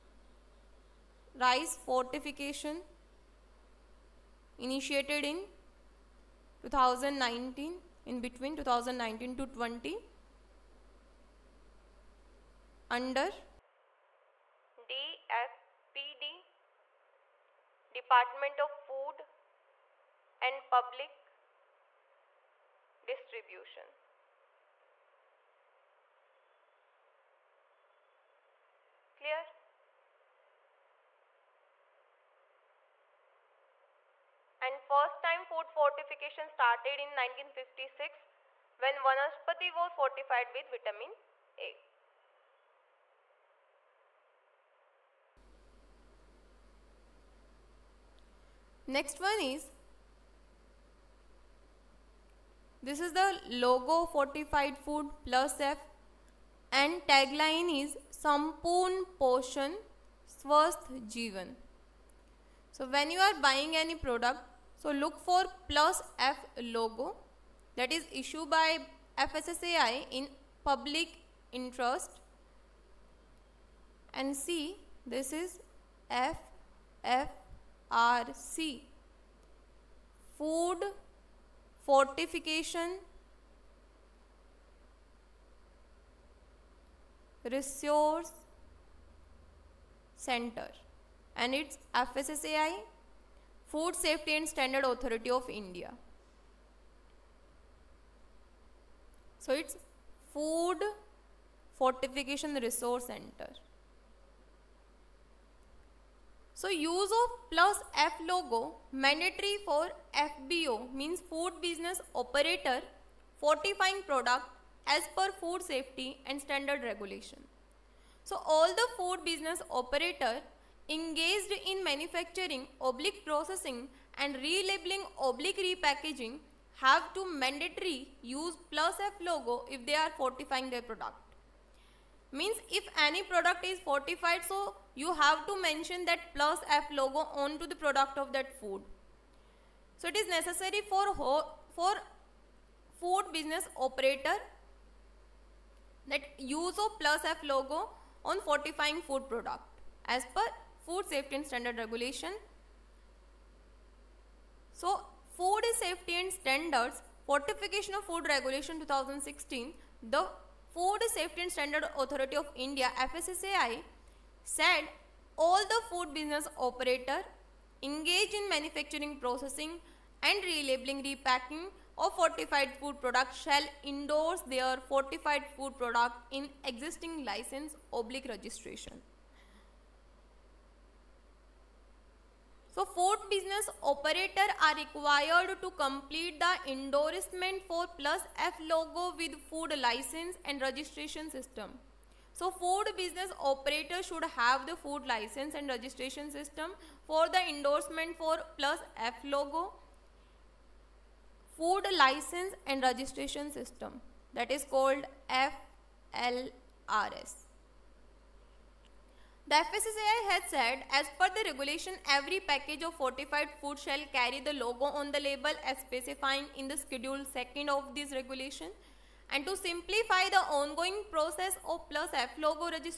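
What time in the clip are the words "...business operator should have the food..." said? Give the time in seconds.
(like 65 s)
192 s.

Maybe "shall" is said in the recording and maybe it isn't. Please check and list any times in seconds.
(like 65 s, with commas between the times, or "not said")
173 s, 213 s.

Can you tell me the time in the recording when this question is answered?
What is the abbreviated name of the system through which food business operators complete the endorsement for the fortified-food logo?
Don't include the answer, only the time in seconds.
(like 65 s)
205 s.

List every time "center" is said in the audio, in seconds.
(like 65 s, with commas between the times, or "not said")
90 s, 103 s.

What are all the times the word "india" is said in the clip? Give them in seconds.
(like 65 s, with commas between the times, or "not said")
95 s, 162 s.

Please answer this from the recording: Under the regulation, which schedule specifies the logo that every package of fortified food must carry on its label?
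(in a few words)
Schedule 2.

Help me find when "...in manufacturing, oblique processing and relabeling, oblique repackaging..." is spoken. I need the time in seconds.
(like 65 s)
121 s.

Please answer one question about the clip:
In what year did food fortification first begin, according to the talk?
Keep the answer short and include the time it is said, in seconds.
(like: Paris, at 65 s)
1956, at 37 s.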